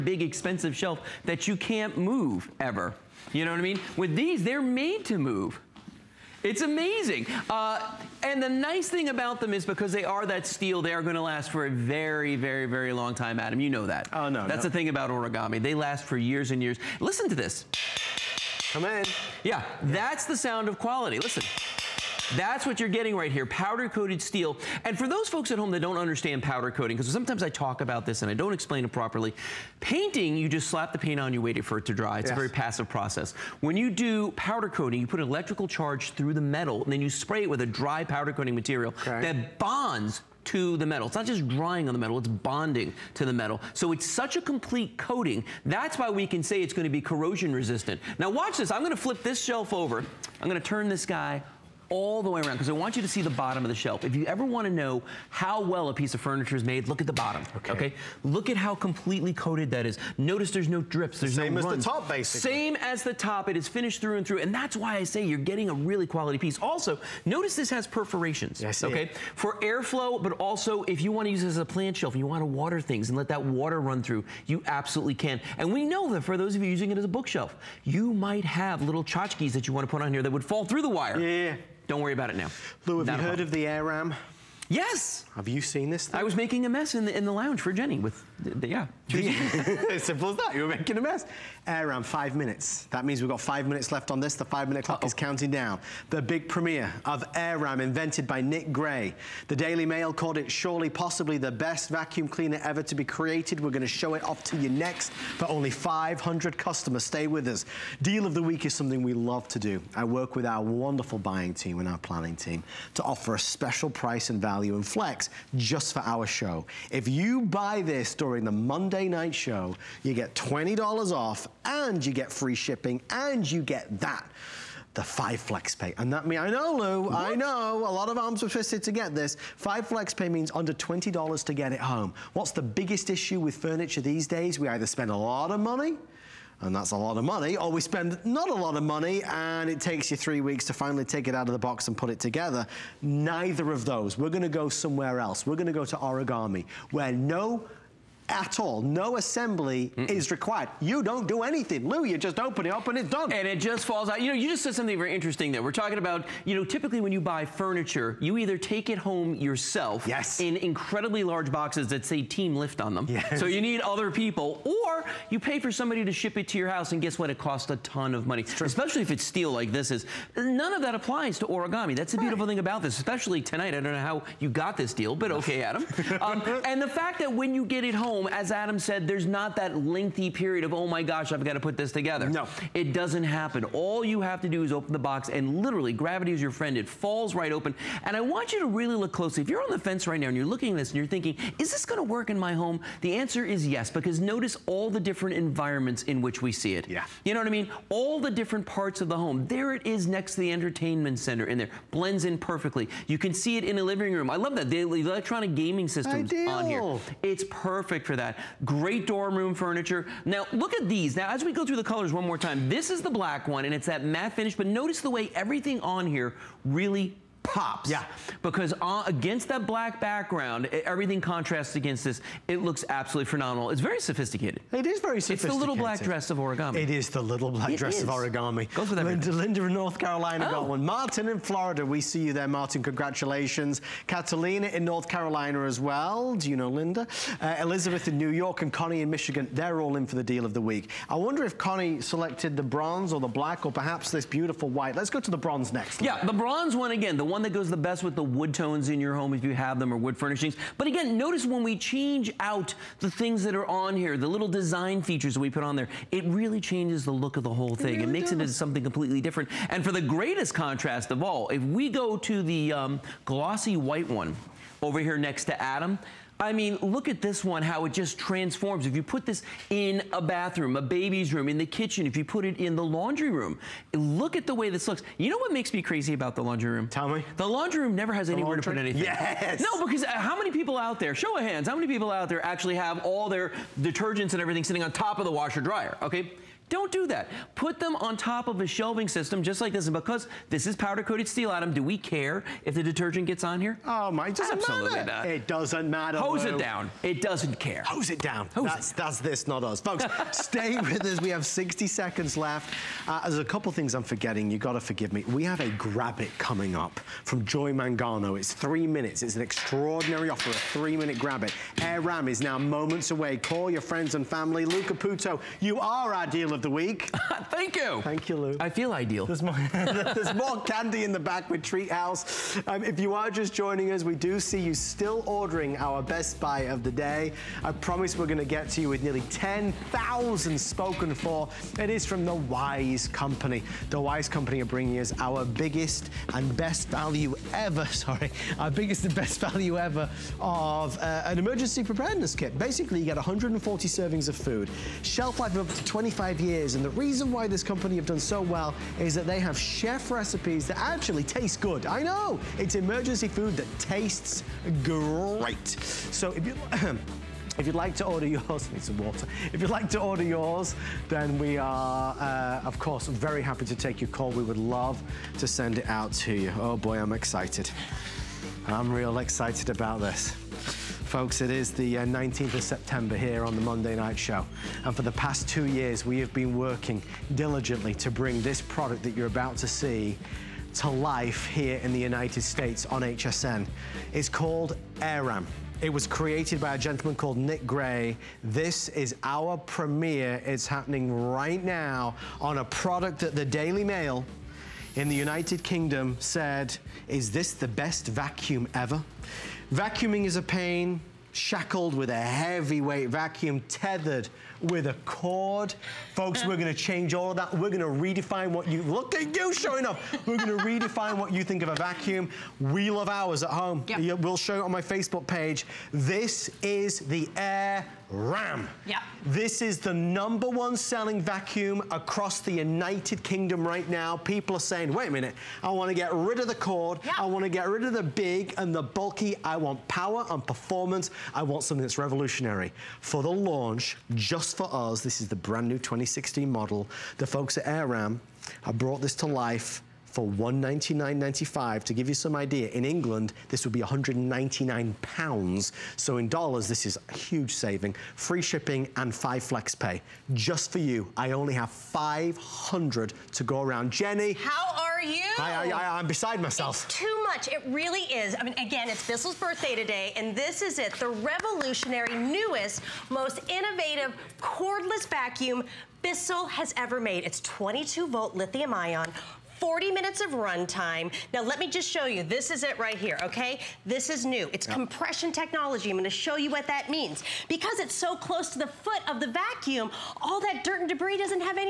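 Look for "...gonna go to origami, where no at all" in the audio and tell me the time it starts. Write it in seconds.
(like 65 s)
145 s.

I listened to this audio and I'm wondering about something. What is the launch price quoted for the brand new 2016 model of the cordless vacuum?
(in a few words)
$199.95.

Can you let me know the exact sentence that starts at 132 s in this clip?
What's the biggest issue with furniture these days?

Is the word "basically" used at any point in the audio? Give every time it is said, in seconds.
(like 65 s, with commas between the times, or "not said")
62 s, 342 s.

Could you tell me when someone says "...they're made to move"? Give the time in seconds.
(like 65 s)
4 s.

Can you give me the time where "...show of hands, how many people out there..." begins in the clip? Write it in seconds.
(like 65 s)
281 s.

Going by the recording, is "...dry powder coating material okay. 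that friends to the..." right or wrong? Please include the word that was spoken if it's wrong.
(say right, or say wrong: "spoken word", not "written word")
wrong: "bonds", not "friends".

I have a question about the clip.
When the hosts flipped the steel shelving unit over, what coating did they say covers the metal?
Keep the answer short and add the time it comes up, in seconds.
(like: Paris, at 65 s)
powder coated steel, at 23 s.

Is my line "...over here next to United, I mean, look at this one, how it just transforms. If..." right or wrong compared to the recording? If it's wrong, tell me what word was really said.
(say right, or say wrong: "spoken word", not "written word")
wrong: "Adam", not "United".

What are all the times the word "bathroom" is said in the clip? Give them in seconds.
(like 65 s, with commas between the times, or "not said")
270 s.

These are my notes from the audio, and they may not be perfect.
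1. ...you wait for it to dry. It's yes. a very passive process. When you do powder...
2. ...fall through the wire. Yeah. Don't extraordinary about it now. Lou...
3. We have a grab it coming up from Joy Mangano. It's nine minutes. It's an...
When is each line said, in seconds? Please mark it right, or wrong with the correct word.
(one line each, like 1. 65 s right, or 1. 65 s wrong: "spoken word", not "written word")
1. 31 s right
2. 80 s wrong: "worry", not "extraordinary"
3. 305 s wrong: "three", not "nine".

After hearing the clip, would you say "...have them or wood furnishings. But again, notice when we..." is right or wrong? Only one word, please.
right.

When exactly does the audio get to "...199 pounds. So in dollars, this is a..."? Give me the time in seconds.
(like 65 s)
443 s.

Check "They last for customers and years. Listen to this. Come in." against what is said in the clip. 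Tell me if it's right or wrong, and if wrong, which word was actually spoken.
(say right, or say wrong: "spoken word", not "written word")
wrong: "years", not "customers".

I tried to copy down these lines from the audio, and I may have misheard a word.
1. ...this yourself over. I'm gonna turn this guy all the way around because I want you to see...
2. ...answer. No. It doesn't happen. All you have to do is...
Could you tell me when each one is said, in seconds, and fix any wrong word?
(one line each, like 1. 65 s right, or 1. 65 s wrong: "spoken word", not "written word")
1. 49 s wrong: "shelf", not "yourself"
2. 181 s wrong: "together", not "answer".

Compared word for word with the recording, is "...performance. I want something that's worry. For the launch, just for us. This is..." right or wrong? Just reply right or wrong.
wrong.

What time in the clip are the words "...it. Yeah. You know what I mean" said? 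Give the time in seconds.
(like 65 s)
196 s.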